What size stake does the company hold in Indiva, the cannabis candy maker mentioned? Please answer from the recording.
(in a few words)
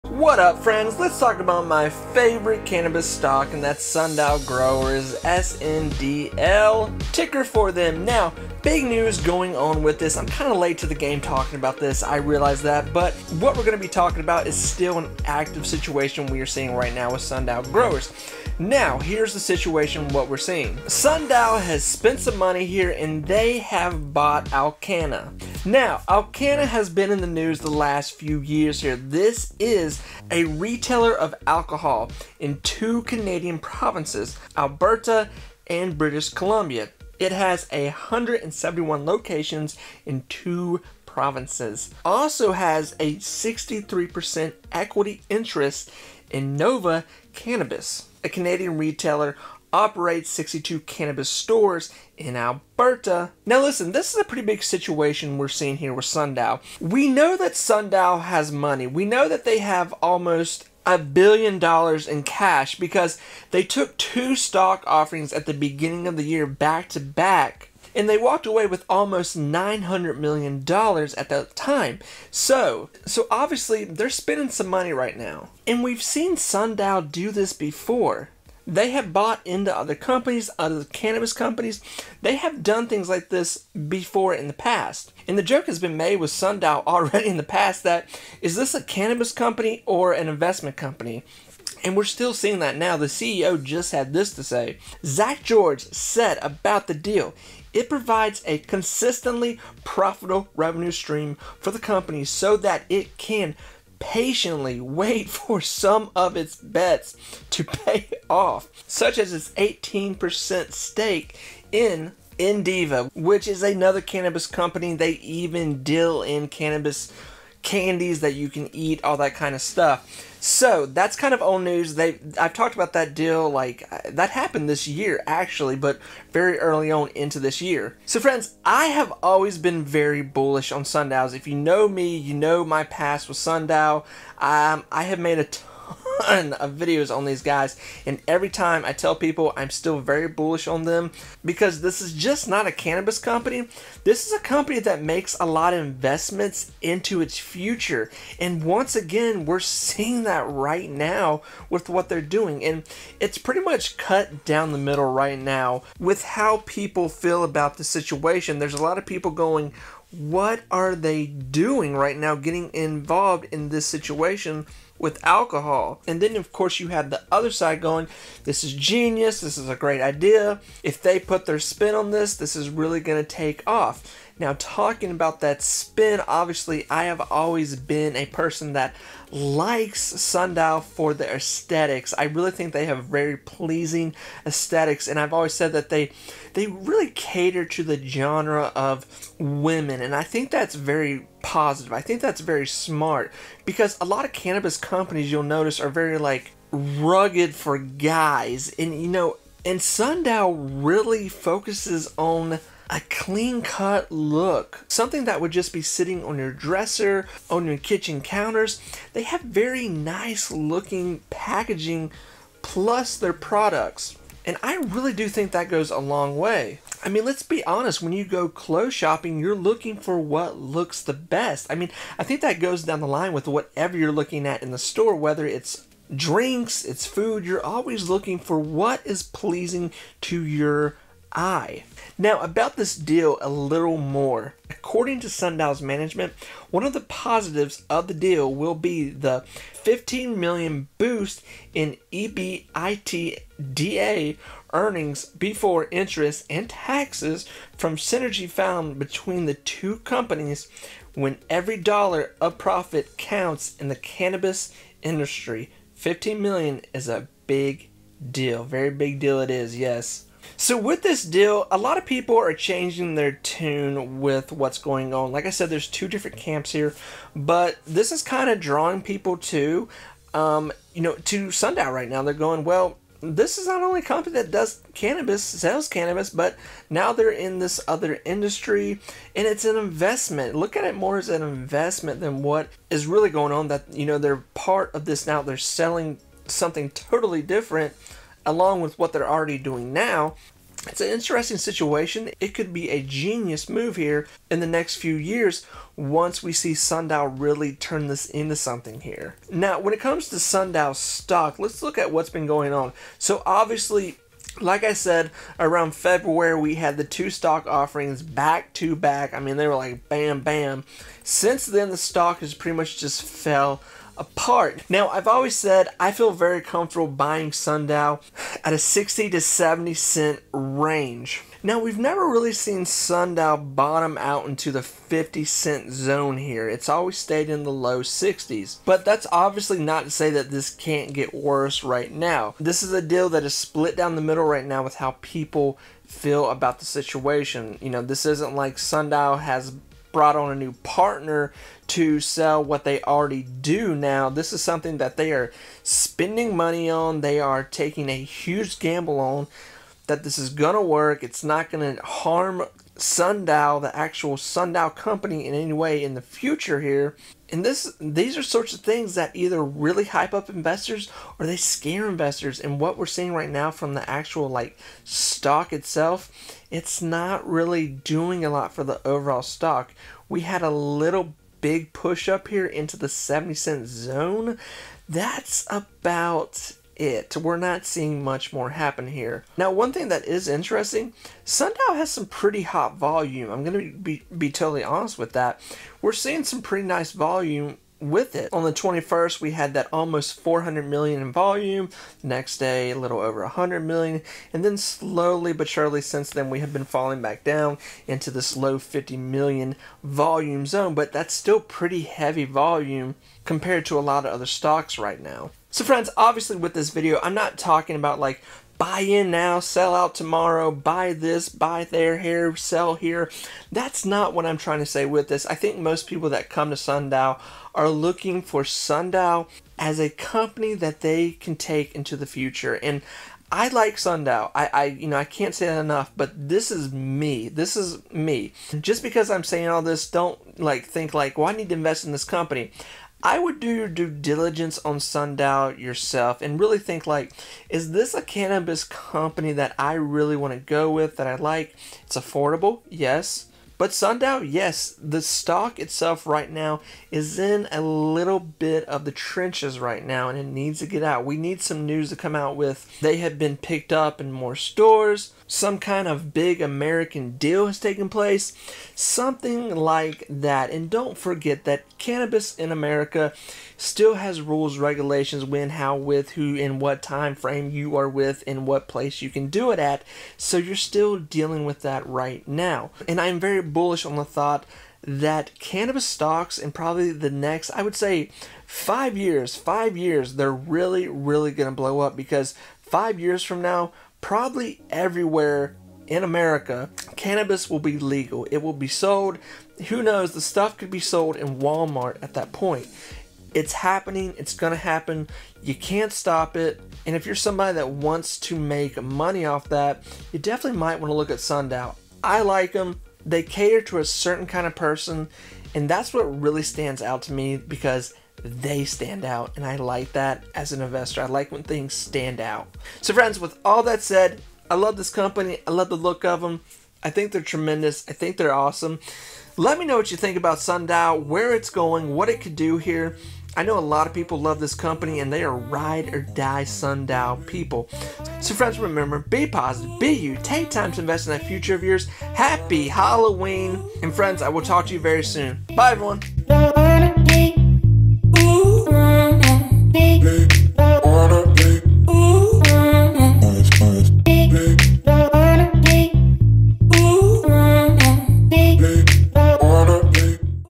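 18%.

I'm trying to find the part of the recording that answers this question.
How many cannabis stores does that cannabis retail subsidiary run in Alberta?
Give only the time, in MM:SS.
00:50.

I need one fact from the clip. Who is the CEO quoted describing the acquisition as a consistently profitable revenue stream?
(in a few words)
Zach George.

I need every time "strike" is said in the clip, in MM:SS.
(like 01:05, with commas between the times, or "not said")
not said.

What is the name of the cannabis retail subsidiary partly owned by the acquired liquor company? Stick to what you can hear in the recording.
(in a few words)
Nova Cannabis.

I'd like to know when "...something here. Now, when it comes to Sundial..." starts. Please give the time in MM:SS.
04:58.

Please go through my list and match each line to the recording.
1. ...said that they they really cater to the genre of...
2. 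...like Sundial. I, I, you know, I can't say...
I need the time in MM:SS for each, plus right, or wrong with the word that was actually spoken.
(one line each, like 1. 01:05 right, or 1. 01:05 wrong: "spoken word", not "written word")
1. 03:05 right
2. 07:03 right.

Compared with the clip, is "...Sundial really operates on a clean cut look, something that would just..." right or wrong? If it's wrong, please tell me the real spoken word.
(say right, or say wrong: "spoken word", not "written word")
wrong: "focuses", not "operates".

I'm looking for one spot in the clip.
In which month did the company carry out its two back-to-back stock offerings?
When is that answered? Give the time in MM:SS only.
05:05.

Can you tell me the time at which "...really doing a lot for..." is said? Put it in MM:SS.
06:07.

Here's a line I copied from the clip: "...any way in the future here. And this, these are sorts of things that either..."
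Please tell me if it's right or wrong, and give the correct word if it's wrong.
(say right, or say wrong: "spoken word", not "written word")
right.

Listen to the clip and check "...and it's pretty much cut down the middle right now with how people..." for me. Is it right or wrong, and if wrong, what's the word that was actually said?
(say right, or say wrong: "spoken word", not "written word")
right.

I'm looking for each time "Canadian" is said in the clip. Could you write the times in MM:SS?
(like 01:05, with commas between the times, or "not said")
00:33, 00:48.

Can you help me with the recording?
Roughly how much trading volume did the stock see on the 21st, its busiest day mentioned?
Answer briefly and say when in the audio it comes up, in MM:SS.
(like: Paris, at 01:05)
almost 400 million, at 06:29.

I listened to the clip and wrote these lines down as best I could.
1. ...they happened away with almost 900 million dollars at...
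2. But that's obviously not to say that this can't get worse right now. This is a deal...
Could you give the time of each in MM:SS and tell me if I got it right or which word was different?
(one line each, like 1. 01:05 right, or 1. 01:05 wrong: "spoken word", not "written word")
1. 01:08 wrong: "walked", not "happened"
2. 05:28 right.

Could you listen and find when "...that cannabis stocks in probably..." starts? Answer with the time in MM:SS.
07:55.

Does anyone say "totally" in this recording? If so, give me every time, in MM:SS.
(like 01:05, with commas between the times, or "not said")
04:46, 06:24.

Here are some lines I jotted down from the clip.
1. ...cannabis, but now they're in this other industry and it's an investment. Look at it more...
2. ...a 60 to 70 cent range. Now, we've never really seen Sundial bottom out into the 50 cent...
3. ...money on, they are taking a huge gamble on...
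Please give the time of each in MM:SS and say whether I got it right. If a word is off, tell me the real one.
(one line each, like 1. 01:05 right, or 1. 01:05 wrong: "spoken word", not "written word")
1. 04:35 right
2. 05:18 right
3. 05:46 right.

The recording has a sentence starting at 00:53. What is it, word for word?
Now listen, this is a pretty big situation we're seeing here with Sundial.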